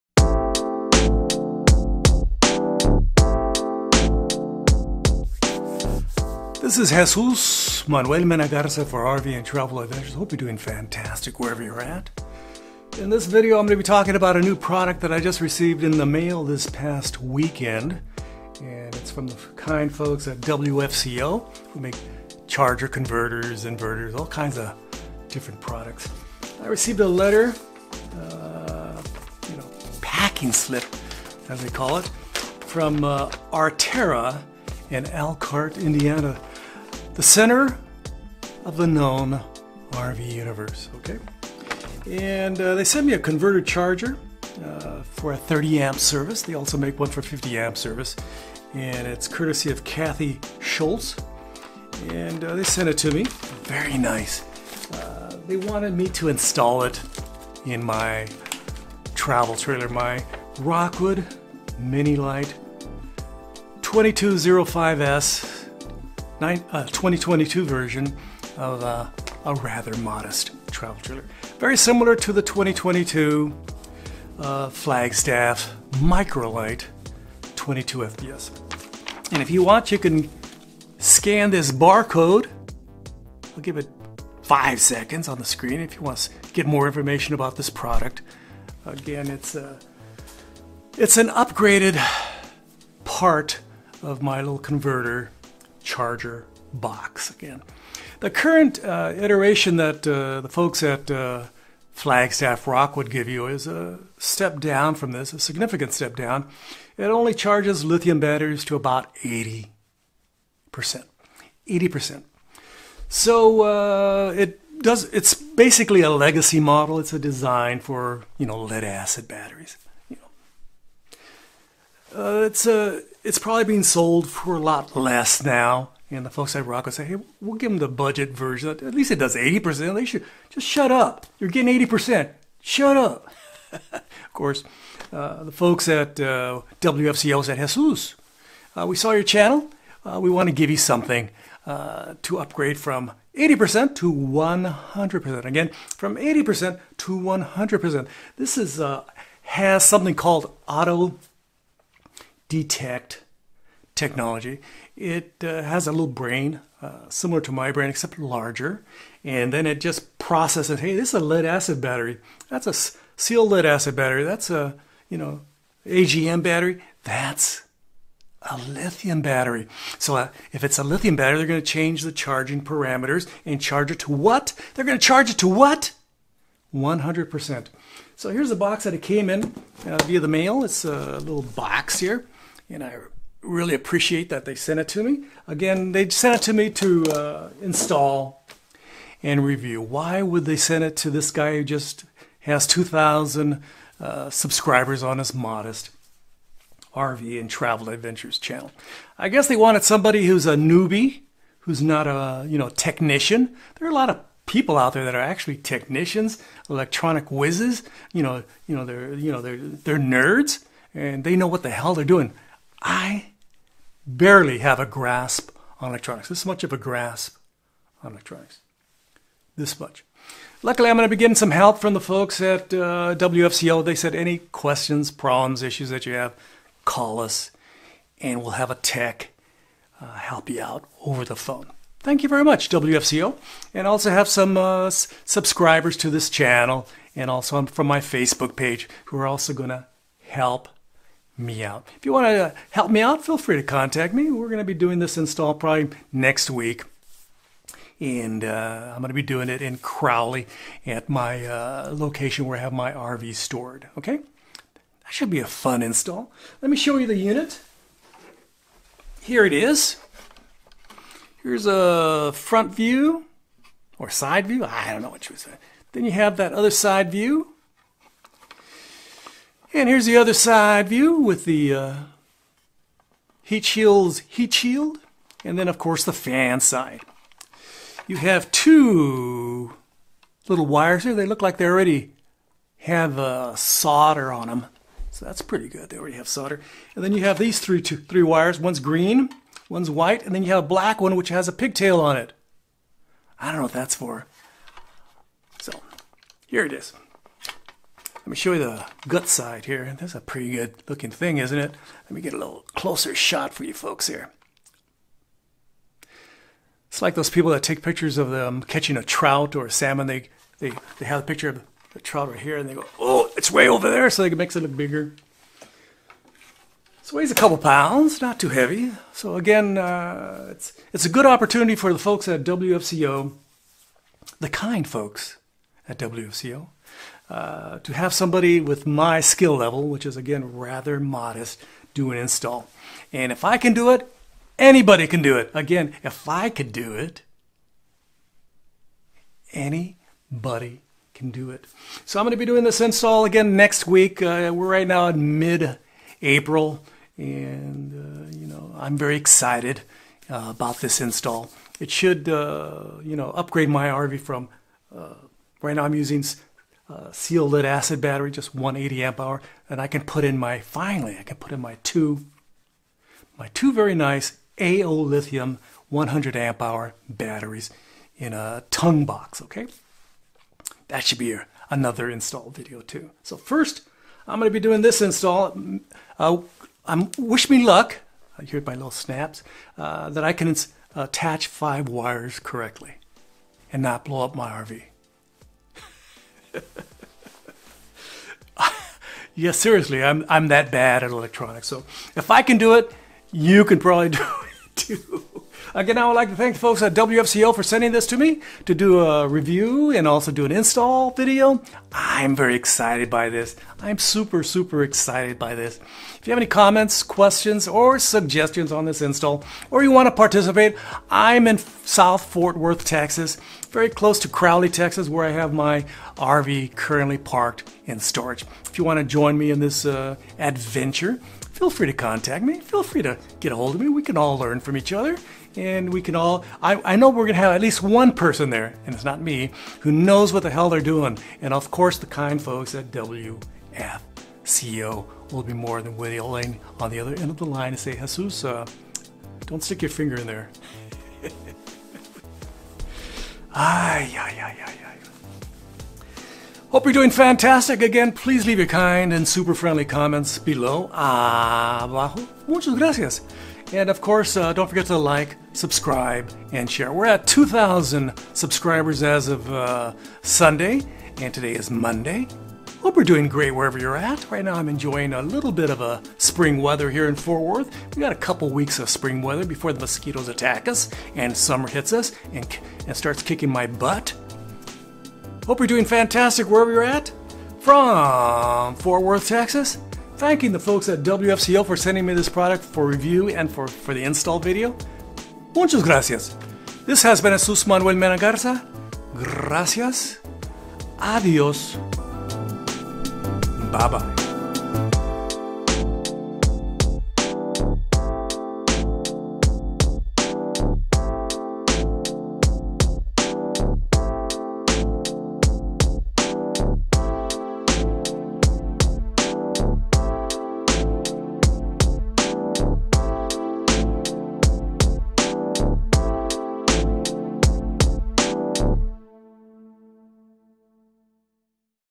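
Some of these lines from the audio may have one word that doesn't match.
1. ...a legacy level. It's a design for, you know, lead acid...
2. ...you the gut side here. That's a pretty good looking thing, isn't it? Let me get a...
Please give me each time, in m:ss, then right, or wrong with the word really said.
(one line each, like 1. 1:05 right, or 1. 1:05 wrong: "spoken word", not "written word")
1. 1:56 wrong: "model", not "level"
2. 4:58 right.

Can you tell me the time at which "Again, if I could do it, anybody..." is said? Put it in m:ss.
5:35.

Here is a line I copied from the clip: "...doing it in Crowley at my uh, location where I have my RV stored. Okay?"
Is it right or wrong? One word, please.
right.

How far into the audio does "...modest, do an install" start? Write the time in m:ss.
5:30.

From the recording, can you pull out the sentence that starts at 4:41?
They look like they already have uh, solder on them.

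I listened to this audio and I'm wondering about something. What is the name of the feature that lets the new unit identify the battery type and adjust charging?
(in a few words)
auto detect technology.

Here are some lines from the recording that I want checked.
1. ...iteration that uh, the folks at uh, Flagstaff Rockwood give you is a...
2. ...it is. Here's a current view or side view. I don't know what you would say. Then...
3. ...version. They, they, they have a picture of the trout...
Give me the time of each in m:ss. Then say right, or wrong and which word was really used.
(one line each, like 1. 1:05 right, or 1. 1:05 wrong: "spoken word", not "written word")
1. 1:39 right
2. 4:19 wrong: "front", not "current"
3. 5:09 wrong: "salmon", not "version".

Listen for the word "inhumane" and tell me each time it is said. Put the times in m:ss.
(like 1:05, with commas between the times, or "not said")
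not said.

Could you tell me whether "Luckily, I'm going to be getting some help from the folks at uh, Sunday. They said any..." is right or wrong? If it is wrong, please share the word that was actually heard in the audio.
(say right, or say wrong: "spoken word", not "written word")
wrong: "WFCO", not "Sunday".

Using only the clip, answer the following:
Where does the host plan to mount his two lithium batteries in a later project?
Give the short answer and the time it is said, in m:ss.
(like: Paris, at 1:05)
tongue box, at 6:08.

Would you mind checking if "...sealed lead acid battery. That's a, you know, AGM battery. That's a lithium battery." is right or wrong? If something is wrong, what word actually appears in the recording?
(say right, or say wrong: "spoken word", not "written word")
right.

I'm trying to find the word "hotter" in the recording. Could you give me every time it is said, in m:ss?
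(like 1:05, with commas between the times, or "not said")
not said.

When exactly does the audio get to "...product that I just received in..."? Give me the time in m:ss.
0:14.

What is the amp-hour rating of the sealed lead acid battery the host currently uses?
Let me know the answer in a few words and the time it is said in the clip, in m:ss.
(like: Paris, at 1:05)
180 amp hour, at 5:58.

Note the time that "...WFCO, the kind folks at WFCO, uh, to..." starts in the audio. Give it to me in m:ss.
5:22.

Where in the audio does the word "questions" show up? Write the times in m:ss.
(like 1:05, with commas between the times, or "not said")
3:44, 6:47.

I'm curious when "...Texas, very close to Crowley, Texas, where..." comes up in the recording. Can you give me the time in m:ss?
6:52.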